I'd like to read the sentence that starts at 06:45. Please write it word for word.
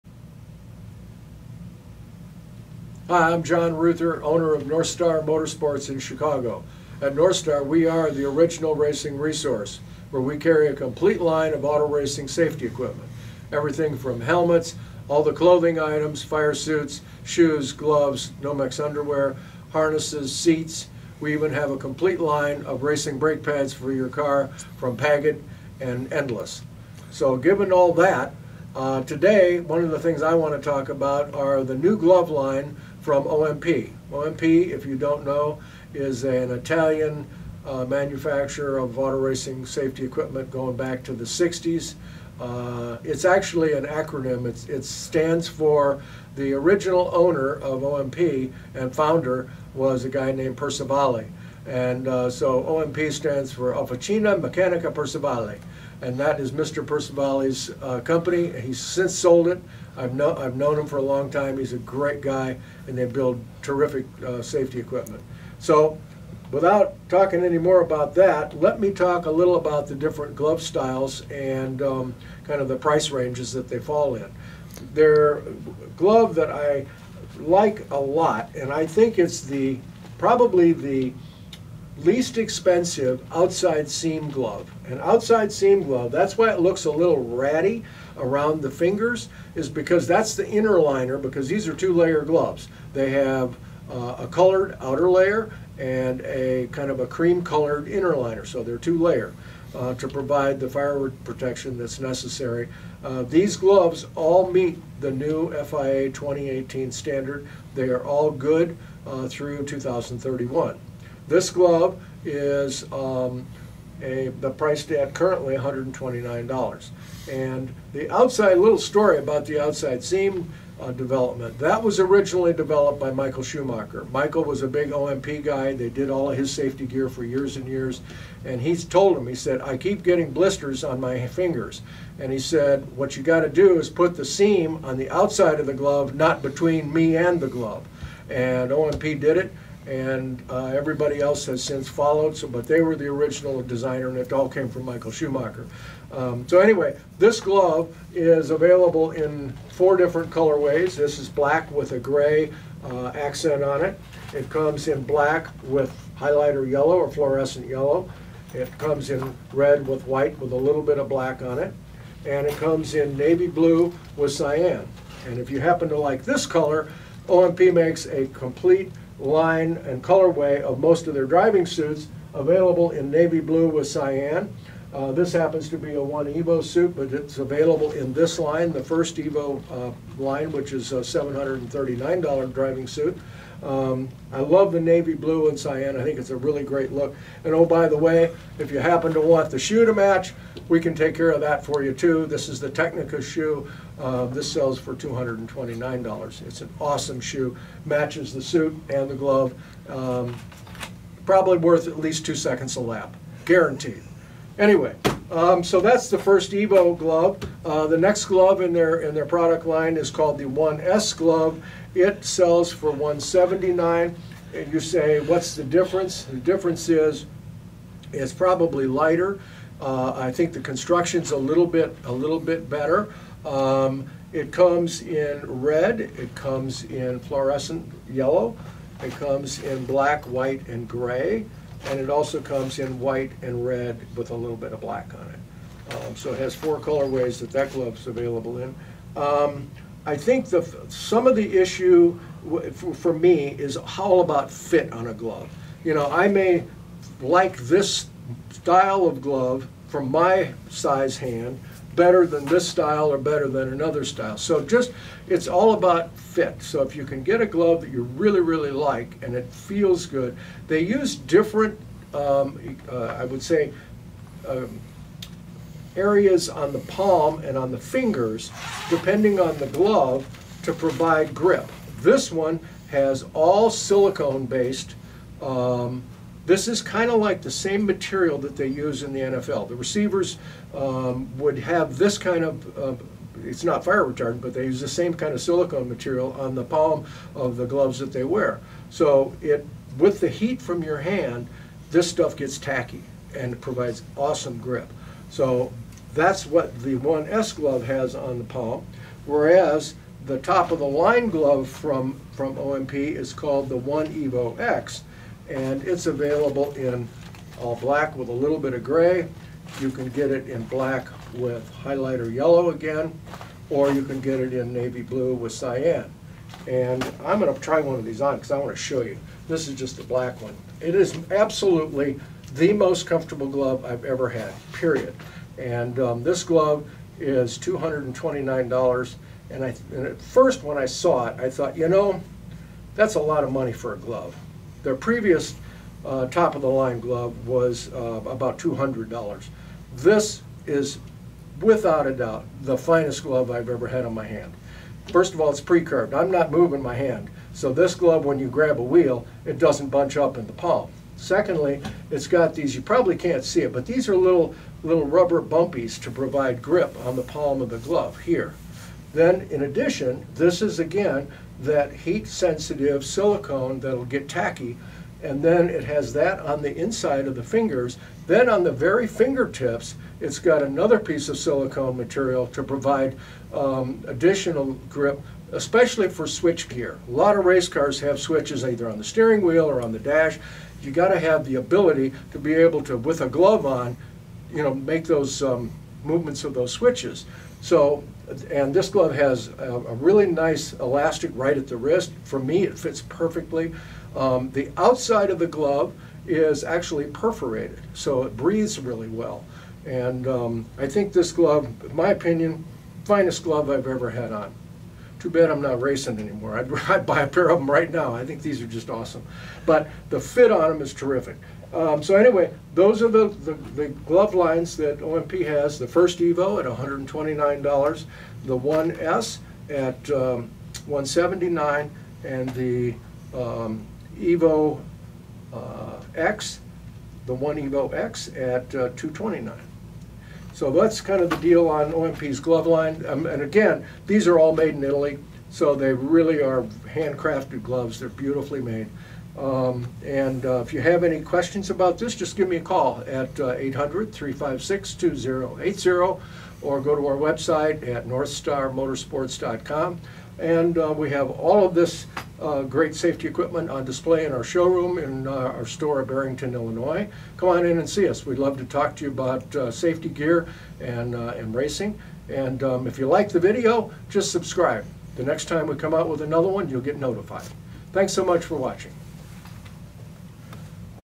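Too bad I'm not racing anymore.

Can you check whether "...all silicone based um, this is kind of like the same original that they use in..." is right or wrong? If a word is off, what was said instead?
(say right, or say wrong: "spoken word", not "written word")
wrong: "material", not "original".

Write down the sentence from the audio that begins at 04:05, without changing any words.
You know, I may like this style of glove from my size hand, better than this style or better than another style.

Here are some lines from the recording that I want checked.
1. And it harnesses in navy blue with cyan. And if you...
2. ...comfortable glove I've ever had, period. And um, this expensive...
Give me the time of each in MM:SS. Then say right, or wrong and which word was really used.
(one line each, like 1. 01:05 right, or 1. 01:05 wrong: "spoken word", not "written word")
1. 02:42 wrong: "comes", not "harnesses"
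2. 05:23 wrong: "glove", not "expensive".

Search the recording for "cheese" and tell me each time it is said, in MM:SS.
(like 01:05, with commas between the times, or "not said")
not said.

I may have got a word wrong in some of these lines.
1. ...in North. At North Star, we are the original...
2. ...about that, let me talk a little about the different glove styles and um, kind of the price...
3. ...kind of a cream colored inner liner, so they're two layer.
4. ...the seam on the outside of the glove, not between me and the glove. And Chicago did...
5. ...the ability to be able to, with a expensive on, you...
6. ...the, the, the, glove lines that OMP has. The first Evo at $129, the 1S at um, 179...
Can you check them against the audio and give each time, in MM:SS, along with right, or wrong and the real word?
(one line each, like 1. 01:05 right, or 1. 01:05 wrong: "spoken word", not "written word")
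1. 00:05 wrong: "Chicago", not "North"
2. 01:07 right
3. 01:36 right
4. 02:14 wrong: "OMP", not "Chicago"
5. 06:21 wrong: "glove", not "expensive"
6. 06:53 right.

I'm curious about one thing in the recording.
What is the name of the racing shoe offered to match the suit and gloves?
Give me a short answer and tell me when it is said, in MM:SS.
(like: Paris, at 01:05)
Tecnica, at 03:12.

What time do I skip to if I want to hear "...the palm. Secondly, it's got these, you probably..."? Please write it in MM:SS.
05:50.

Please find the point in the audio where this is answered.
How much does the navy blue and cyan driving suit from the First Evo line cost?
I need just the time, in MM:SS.
03:00.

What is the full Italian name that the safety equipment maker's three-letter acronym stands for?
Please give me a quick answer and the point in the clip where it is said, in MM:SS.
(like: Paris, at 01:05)
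Officina Meccanica Percivale, at 00:53.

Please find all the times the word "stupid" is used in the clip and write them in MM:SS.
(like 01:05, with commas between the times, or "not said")
not said.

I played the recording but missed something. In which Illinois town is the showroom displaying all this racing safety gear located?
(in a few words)
Barrington.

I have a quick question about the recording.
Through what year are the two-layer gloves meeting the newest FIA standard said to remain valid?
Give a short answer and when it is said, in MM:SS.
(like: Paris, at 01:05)
2031, at 01:49.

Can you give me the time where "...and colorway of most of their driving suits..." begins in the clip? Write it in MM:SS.
02:49.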